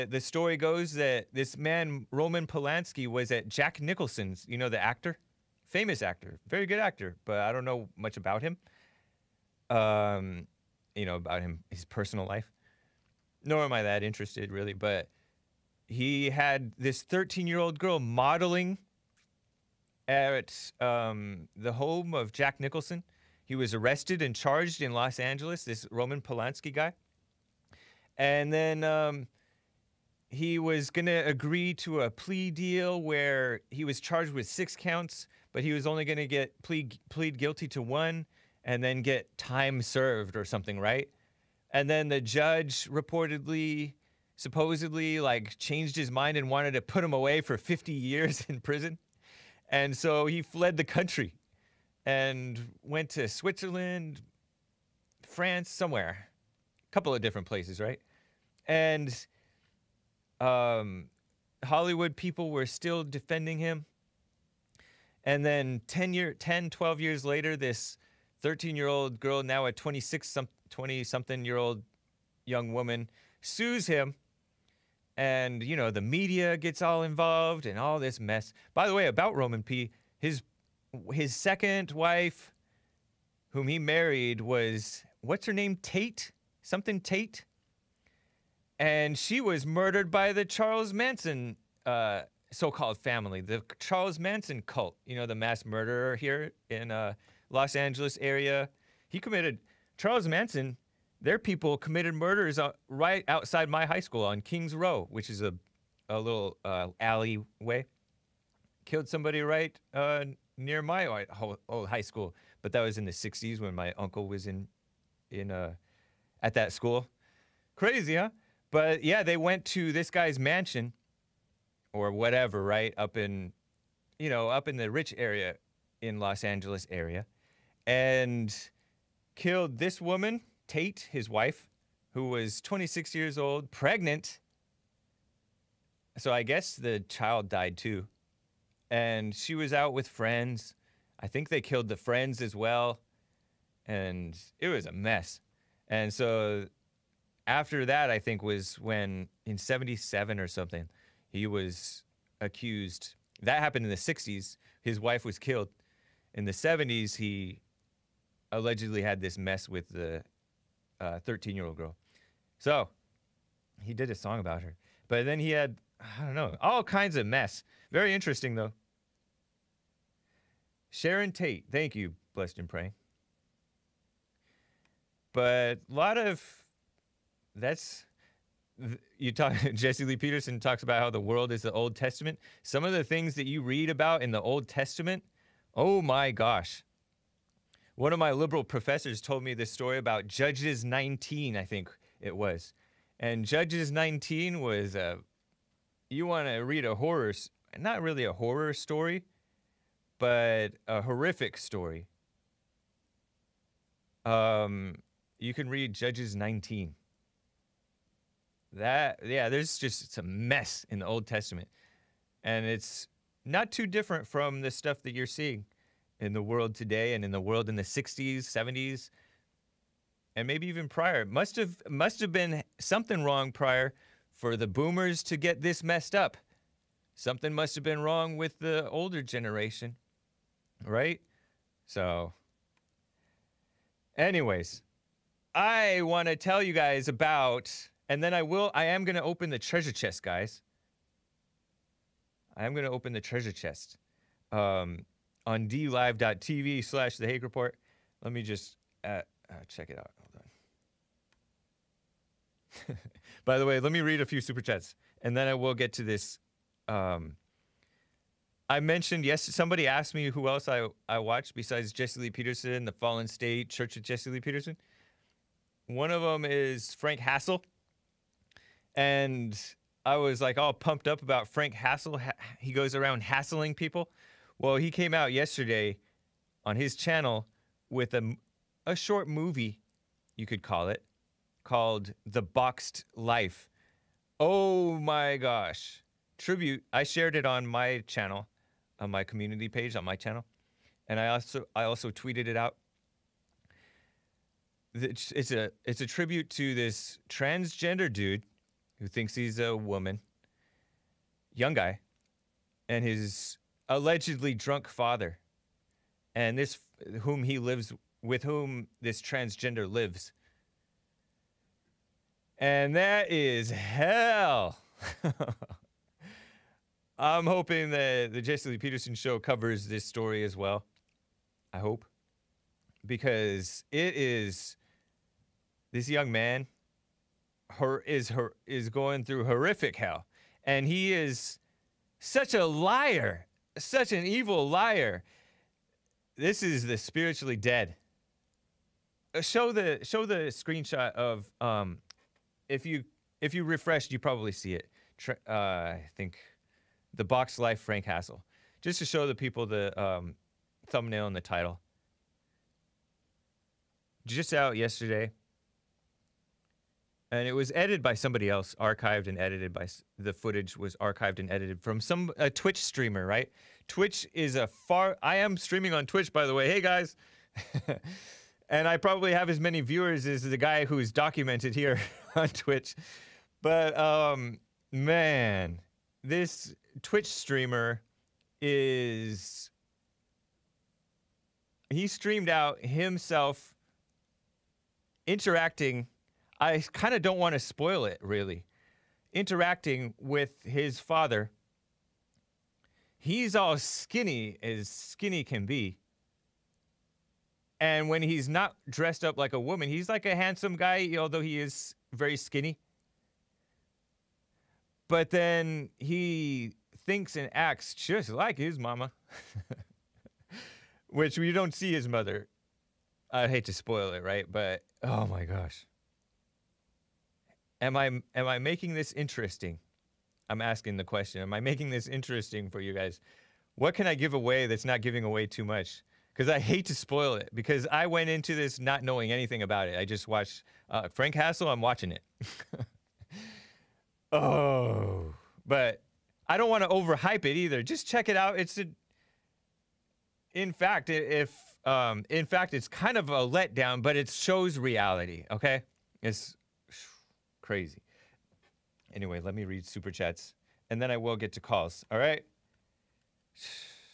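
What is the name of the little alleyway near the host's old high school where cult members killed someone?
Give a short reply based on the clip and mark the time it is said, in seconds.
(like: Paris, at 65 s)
Kings Row, at 104 s.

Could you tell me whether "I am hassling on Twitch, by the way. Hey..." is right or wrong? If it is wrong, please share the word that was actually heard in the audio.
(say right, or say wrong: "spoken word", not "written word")
wrong: "streaming", not "hassling".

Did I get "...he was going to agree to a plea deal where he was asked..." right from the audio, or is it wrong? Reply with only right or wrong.
wrong.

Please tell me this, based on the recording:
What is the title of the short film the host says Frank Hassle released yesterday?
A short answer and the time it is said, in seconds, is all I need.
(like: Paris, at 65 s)
The Boxed Life, at 282 s.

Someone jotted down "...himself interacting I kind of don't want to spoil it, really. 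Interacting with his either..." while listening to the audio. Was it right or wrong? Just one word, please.
wrong.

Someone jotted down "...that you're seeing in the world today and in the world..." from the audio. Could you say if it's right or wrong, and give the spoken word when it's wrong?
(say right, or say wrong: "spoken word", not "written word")
right.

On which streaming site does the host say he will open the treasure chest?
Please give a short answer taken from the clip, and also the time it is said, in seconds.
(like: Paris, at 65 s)
dlive.tv, at 245 s.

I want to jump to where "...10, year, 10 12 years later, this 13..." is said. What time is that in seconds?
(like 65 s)
65 s.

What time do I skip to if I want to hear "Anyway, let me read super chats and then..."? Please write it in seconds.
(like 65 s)
449 s.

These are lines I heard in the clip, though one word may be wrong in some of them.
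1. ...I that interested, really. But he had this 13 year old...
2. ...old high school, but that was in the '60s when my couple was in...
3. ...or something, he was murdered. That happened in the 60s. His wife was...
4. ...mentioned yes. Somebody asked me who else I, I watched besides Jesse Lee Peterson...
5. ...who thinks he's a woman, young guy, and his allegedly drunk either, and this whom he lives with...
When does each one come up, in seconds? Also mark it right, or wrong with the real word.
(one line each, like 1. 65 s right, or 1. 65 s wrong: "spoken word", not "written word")
1. 13 s right
2. 111 s wrong: "uncle", not "couple"
3. 150 s wrong: "accused", not "murdered"
4. 258 s right
5. 298 s wrong: "father", not "either".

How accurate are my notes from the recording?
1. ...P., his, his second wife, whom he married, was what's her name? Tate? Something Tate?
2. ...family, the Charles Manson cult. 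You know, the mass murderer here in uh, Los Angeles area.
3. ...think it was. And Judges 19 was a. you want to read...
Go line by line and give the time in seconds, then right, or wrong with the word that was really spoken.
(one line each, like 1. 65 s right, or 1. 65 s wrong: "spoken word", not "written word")
1. 79 s right
2. 92 s right
3. 191 s right.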